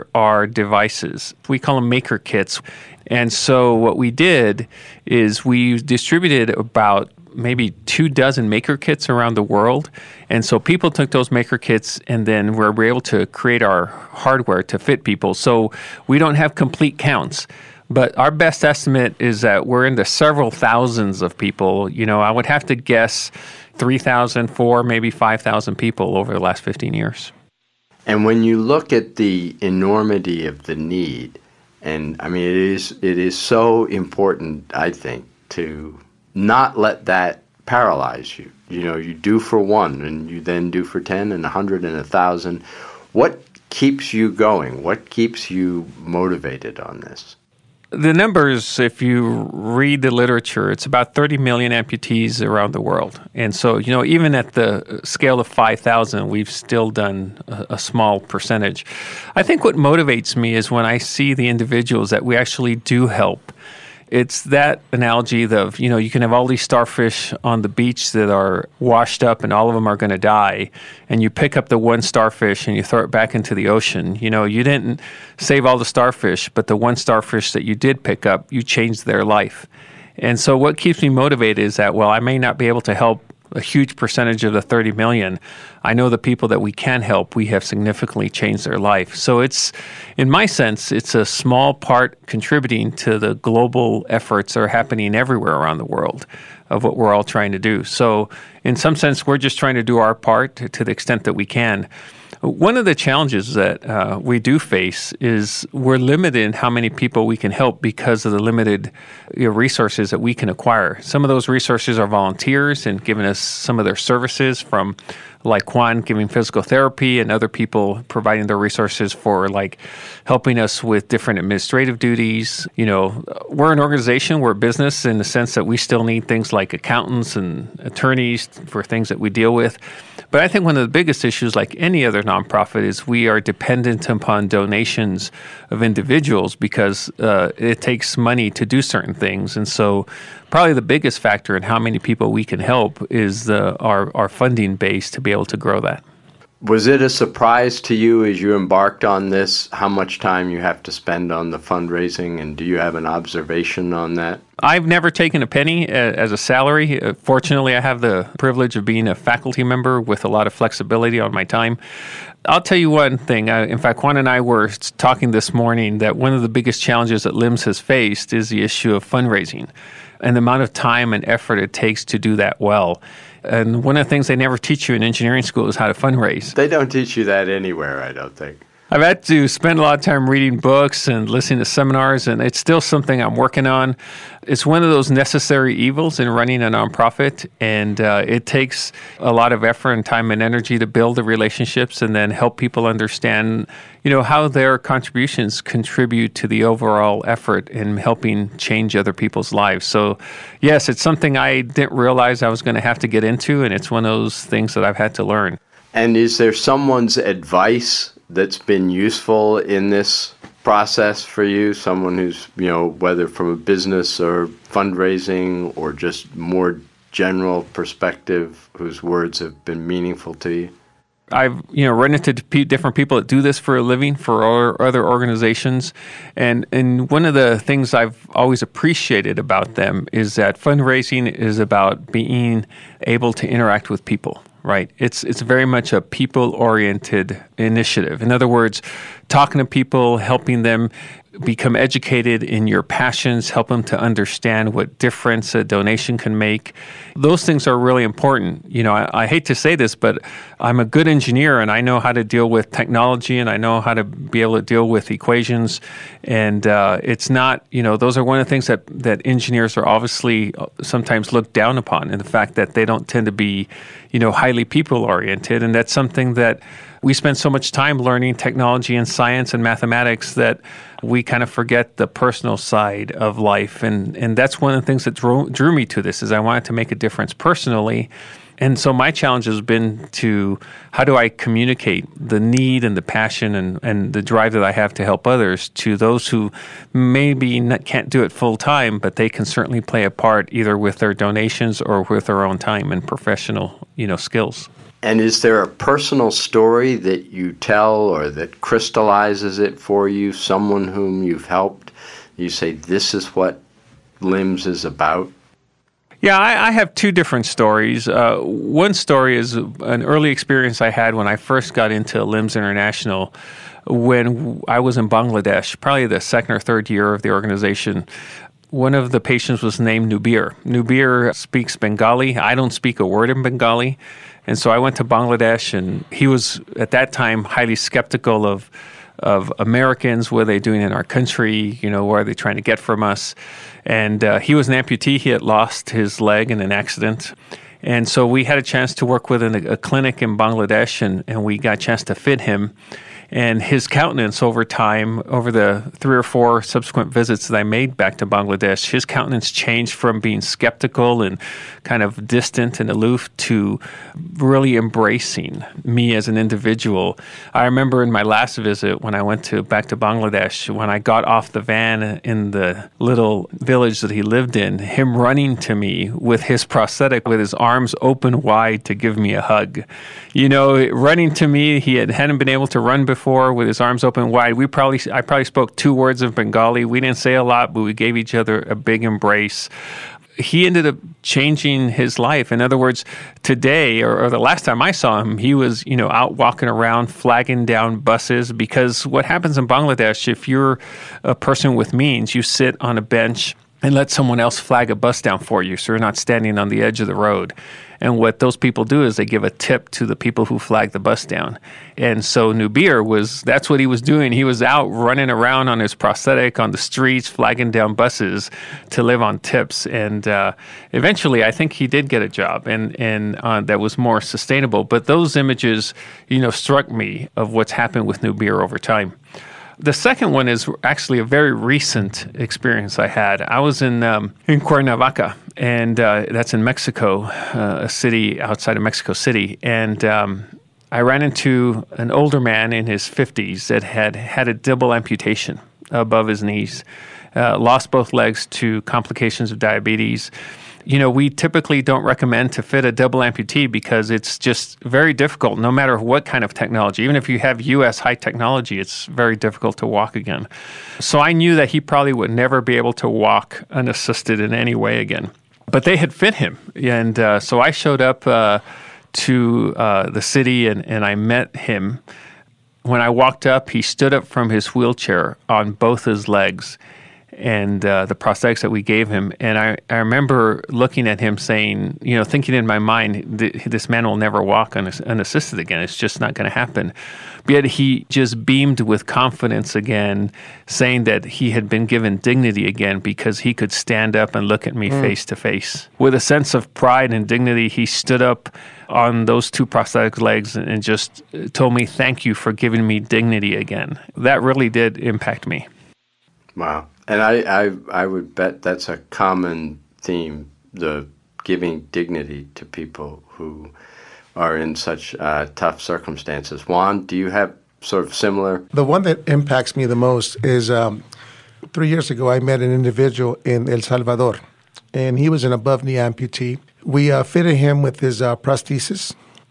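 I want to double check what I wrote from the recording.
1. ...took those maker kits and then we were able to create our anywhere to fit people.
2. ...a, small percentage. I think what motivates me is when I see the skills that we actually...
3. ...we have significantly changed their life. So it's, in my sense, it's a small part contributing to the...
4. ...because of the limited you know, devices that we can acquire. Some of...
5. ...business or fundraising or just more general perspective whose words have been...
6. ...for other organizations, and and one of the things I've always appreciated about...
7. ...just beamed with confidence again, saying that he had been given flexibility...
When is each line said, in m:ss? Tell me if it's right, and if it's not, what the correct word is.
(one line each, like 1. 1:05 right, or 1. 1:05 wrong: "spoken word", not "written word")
1. 0:10 wrong: "hardware", not "anywhere"
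2. 0:57 wrong: "individuals", not "skills"
3. 1:27 right
4. 1:47 wrong: "resources", not "devices"
5. 3:33 right
6. 3:44 right
7. 7:58 wrong: "dignity", not "flexibility".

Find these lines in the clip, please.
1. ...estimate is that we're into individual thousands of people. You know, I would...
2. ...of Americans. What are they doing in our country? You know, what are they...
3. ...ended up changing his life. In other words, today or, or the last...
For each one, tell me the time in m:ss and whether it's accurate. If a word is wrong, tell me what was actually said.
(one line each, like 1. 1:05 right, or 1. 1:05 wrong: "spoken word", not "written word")
1. 0:18 wrong: "several", not "individual"
2. 5:29 right
3. 6:20 right.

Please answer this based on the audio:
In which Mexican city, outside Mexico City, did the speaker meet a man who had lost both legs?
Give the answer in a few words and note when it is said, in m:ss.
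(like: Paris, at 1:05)
Cuernavaca, at 7:04.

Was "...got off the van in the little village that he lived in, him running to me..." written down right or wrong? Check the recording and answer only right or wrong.
right.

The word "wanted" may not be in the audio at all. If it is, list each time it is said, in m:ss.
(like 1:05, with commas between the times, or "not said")
4:36.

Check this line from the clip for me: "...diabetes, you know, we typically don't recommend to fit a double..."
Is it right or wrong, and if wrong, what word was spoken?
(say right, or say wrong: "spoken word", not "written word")
right.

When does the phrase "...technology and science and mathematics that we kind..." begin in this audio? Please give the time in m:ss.
4:28.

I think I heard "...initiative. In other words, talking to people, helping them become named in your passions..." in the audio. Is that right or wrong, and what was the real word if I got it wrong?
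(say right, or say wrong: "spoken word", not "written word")
wrong: "educated", not "named".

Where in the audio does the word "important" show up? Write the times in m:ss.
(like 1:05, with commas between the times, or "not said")
0:33, 4:08.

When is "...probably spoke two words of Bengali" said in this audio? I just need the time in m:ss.
6:15.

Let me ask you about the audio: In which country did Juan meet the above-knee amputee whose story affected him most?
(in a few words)
El Salvador.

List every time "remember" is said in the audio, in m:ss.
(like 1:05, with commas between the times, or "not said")
5:57, 7:49.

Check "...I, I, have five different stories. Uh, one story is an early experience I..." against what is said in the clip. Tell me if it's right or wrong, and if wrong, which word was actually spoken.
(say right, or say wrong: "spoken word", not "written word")
wrong: "two", not "five".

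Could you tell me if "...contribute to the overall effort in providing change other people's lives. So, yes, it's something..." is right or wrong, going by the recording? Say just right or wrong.
wrong.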